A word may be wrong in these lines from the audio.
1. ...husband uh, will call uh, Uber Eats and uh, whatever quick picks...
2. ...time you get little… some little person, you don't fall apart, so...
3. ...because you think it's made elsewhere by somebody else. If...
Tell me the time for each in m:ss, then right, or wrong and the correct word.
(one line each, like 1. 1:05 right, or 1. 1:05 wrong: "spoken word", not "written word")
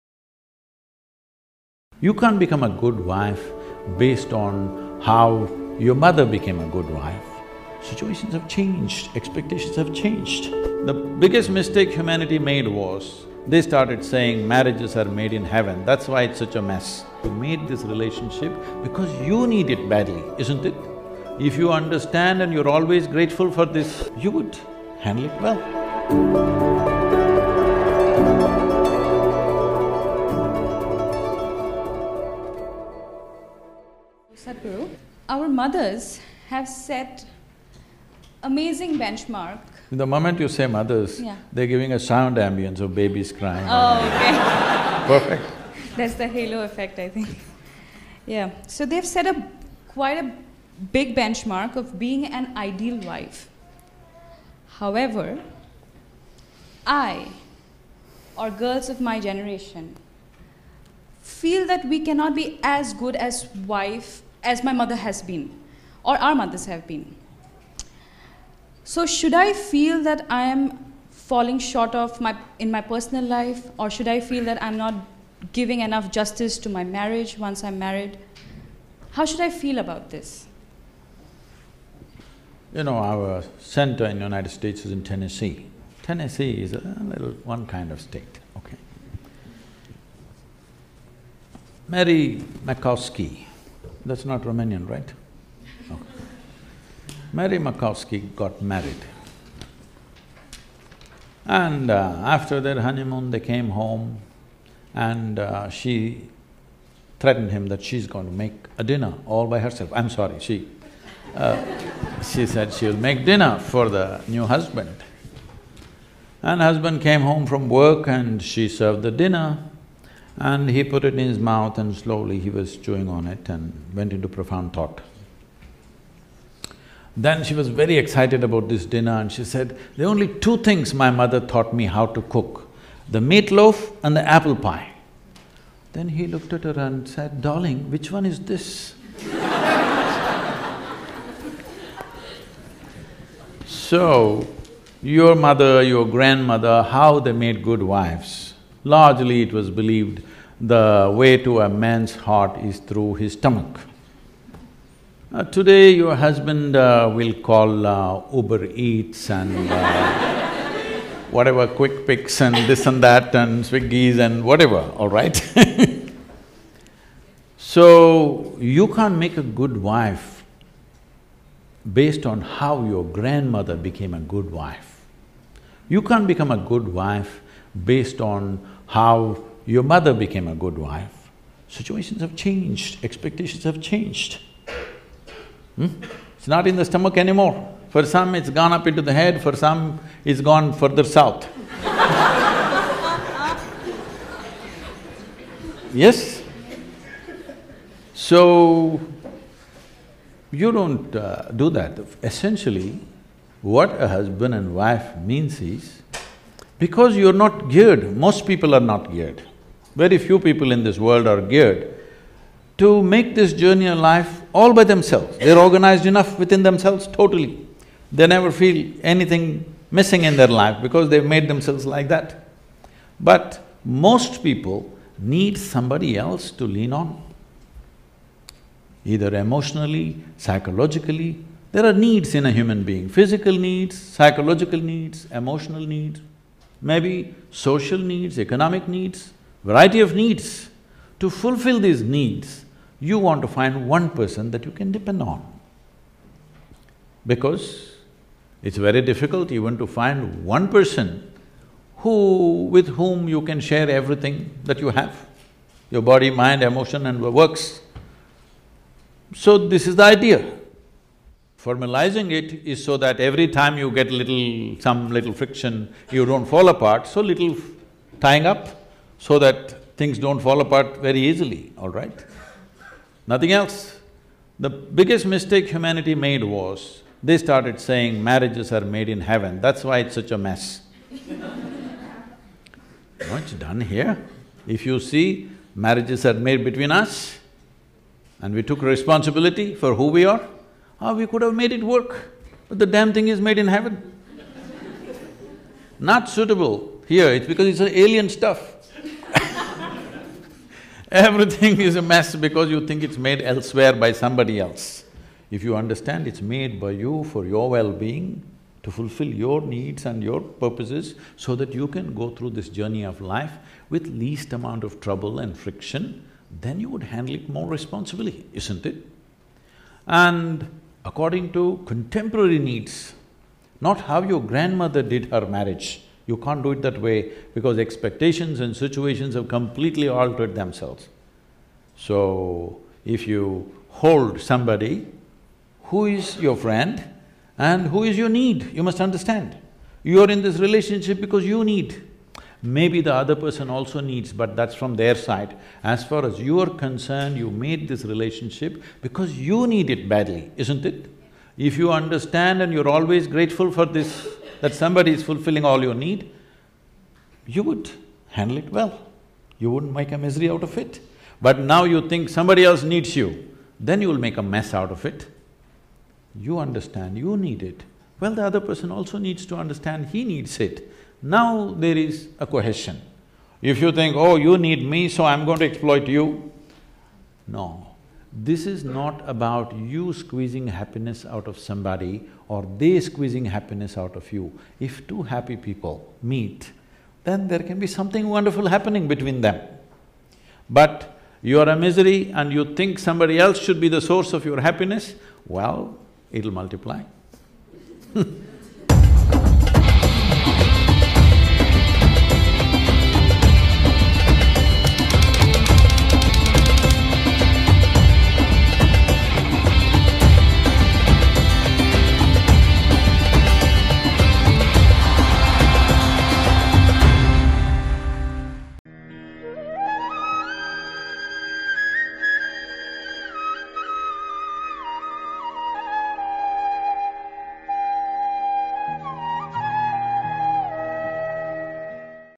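1. 2:36 right
2. 4:23 wrong: "friction", not "person"
3. 5:02 right.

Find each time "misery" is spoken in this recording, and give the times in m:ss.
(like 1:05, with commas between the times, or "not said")
6:00, 6:31.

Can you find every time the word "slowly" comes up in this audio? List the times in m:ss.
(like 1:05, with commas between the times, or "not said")
2:01.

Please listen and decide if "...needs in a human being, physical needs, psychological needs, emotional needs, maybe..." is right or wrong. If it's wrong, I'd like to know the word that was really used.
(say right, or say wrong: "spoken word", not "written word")
right.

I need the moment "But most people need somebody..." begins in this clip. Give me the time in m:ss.
3:43.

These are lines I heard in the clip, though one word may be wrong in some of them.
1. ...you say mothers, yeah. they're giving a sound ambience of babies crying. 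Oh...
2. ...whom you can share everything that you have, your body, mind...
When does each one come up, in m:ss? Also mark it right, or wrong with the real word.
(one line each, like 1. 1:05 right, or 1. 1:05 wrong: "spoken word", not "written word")
1. 0:40 right
2. 4:12 right.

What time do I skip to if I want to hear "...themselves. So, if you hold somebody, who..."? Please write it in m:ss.
5:30.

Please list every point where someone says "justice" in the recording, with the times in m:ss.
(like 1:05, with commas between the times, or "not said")
1:16.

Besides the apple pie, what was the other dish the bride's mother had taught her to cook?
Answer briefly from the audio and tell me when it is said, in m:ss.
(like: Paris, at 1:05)
Meatloaf, at 2:13.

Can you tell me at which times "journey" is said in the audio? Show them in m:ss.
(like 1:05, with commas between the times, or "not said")
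3:33, 5:12.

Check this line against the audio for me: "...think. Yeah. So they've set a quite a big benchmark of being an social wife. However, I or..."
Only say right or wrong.
wrong.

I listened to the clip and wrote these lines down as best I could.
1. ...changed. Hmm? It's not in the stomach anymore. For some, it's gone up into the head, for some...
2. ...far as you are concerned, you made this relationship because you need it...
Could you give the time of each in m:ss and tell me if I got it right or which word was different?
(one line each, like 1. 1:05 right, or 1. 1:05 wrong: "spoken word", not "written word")
1. 3:03 right
2. 5:46 right.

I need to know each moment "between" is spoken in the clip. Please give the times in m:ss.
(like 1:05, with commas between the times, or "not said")
4:46, 6:29.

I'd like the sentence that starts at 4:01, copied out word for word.
To fulfill these needs, you want to find one person that you can depend on.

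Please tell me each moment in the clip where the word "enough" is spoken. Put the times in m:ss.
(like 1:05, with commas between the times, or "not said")
1:15, 3:36.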